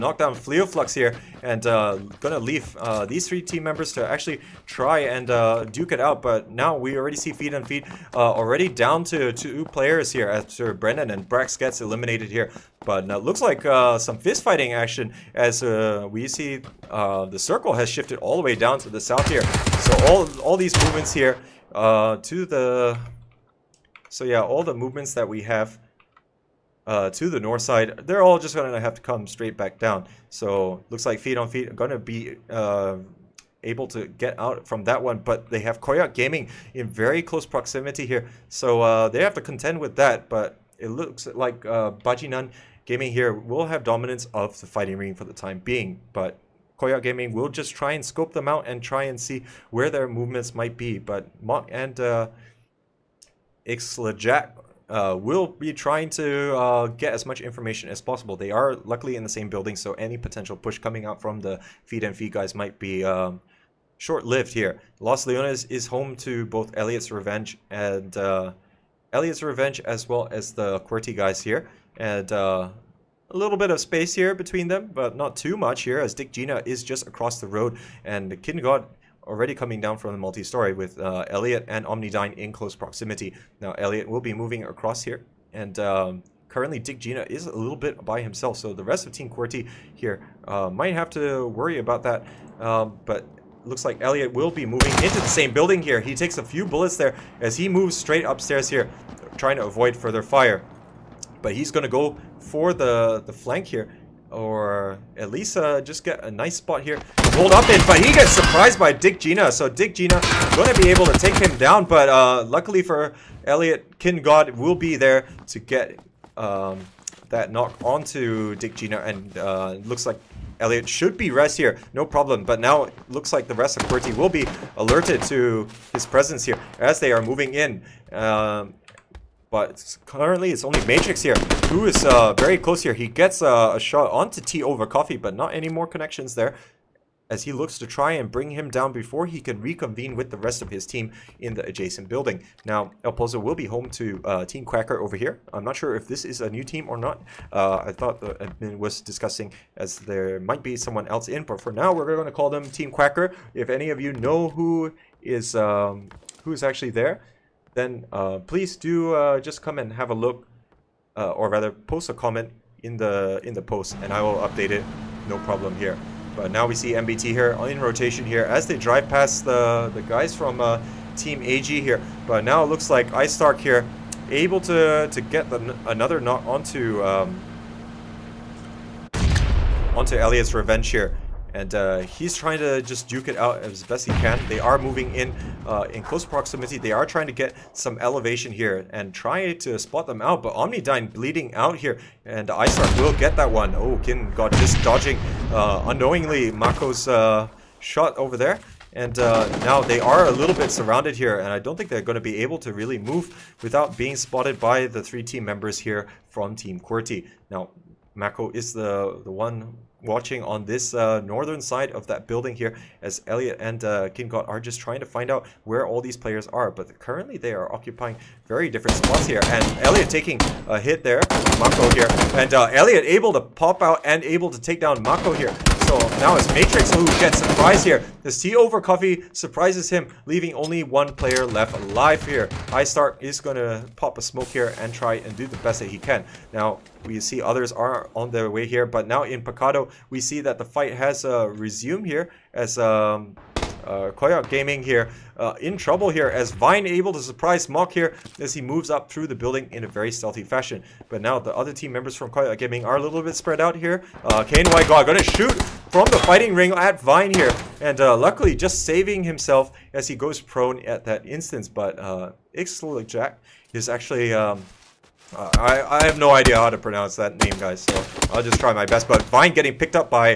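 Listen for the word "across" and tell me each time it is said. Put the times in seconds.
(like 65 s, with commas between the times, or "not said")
77 s, 84 s.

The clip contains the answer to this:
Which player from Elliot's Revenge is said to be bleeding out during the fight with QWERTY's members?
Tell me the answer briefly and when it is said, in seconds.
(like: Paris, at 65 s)
OmniDyne, at 190 s.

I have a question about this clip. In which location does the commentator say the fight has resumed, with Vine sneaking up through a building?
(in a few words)
Picado.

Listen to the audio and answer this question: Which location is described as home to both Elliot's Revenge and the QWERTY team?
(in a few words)
Los Leones.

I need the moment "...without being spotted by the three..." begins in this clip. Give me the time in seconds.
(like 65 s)
203 s.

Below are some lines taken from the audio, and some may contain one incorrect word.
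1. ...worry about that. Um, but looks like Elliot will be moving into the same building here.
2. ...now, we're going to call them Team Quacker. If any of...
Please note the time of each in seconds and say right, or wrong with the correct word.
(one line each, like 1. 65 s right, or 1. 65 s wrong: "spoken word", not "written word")
1. 91 s right
2. 151 s right.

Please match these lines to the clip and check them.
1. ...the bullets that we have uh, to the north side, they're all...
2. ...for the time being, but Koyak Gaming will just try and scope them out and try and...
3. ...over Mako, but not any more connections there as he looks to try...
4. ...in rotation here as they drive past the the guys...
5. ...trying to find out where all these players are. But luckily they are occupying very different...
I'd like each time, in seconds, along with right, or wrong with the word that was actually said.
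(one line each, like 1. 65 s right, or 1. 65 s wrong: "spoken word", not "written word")
1. 24 s wrong: "movements", not "bullets"
2. 45 s right
3. 134 s wrong: "Coffee", not "Mako"
4. 167 s right
5. 214 s wrong: "currently", not "luckily".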